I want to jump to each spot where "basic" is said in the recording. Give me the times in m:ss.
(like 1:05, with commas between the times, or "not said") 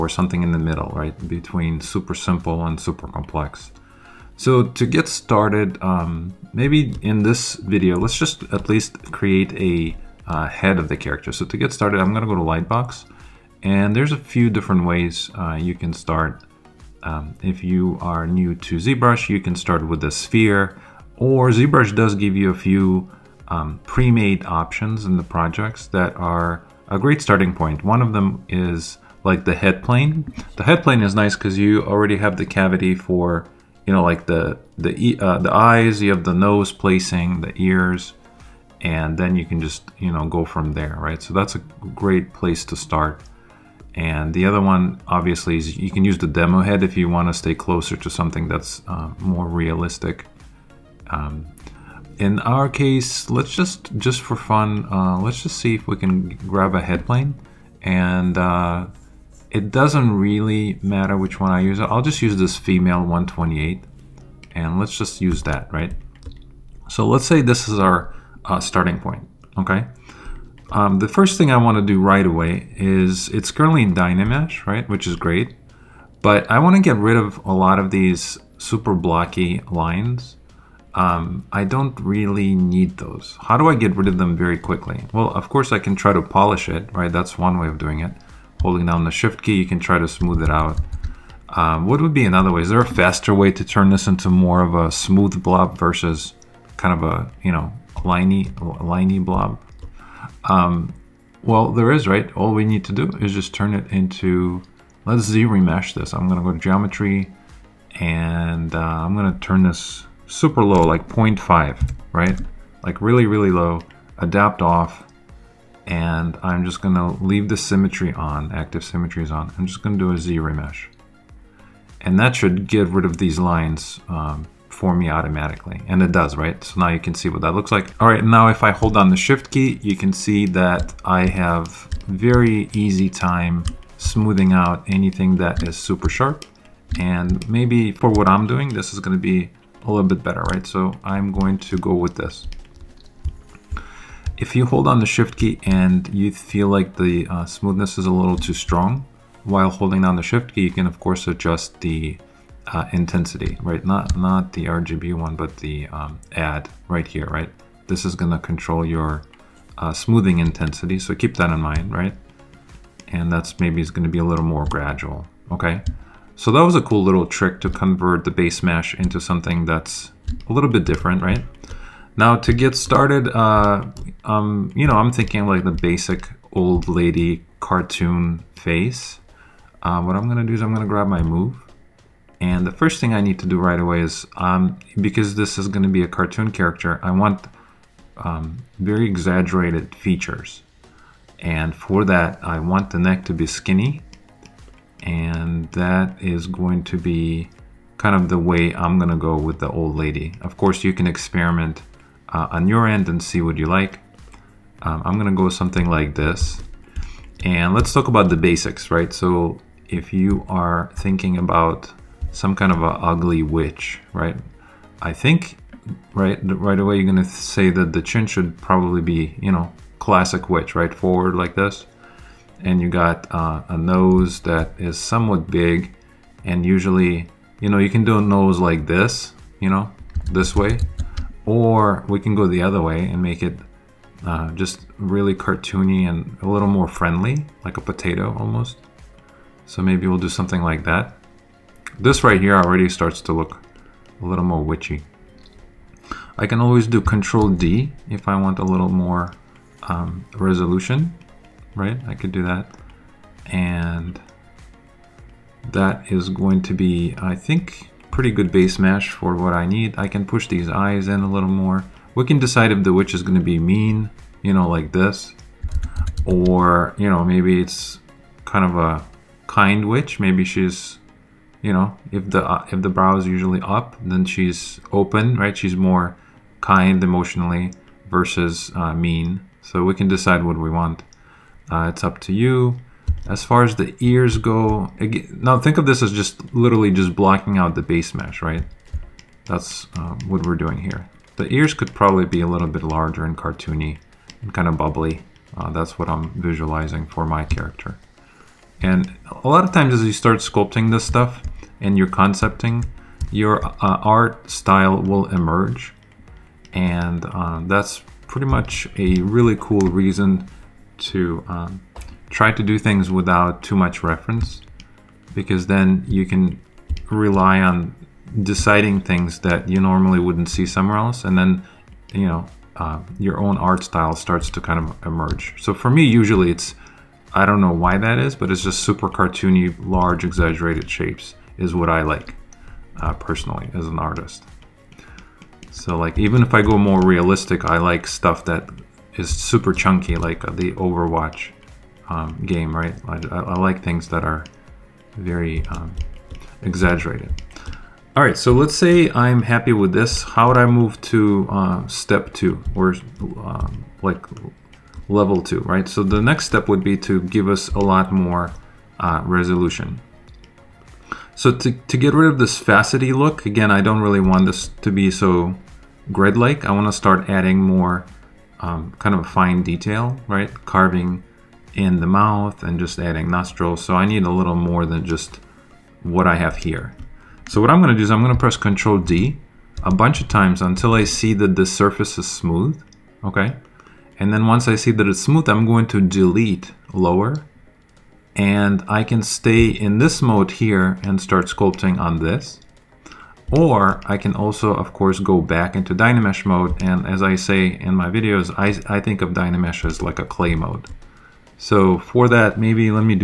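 2:55, 3:28.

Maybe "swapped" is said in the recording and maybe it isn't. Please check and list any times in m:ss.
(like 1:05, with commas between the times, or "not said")
not said.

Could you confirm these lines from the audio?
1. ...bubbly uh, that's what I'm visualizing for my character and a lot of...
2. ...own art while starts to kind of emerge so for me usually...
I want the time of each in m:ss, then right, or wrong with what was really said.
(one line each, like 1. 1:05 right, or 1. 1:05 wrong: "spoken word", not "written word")
1. 4:54 right
2. 5:23 wrong: "style", not "while".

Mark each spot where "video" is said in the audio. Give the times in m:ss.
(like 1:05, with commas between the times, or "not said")
0:07, 6:38.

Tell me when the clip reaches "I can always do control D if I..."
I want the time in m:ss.
4:06.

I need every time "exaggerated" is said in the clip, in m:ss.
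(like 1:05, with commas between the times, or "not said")
3:09, 5:30, 5:46.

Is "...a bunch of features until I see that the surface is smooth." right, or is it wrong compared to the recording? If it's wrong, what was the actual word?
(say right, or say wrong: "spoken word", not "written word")
wrong: "times", not "features".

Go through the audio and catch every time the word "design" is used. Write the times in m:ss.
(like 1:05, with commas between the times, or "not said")
not said.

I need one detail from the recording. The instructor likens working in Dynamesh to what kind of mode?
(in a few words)
Clay mode.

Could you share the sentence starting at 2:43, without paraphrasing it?
And that's maybe is gonna be a little more gradual, okay?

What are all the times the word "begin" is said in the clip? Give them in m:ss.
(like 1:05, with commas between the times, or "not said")
not said.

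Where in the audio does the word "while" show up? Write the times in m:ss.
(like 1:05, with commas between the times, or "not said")
2:29.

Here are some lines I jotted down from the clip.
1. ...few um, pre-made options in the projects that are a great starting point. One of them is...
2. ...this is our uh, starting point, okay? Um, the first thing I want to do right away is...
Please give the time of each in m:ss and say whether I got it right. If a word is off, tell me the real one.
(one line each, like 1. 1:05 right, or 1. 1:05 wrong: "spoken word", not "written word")
1. 0:22 right
2. 1:07 right.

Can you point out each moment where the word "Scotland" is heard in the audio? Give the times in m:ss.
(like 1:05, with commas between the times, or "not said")
not said.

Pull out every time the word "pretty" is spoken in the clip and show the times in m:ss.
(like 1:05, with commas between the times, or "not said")
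4:18, 5:08.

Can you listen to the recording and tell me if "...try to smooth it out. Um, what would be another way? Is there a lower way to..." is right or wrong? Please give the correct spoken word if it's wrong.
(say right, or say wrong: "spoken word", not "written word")
wrong: "faster", not "lower".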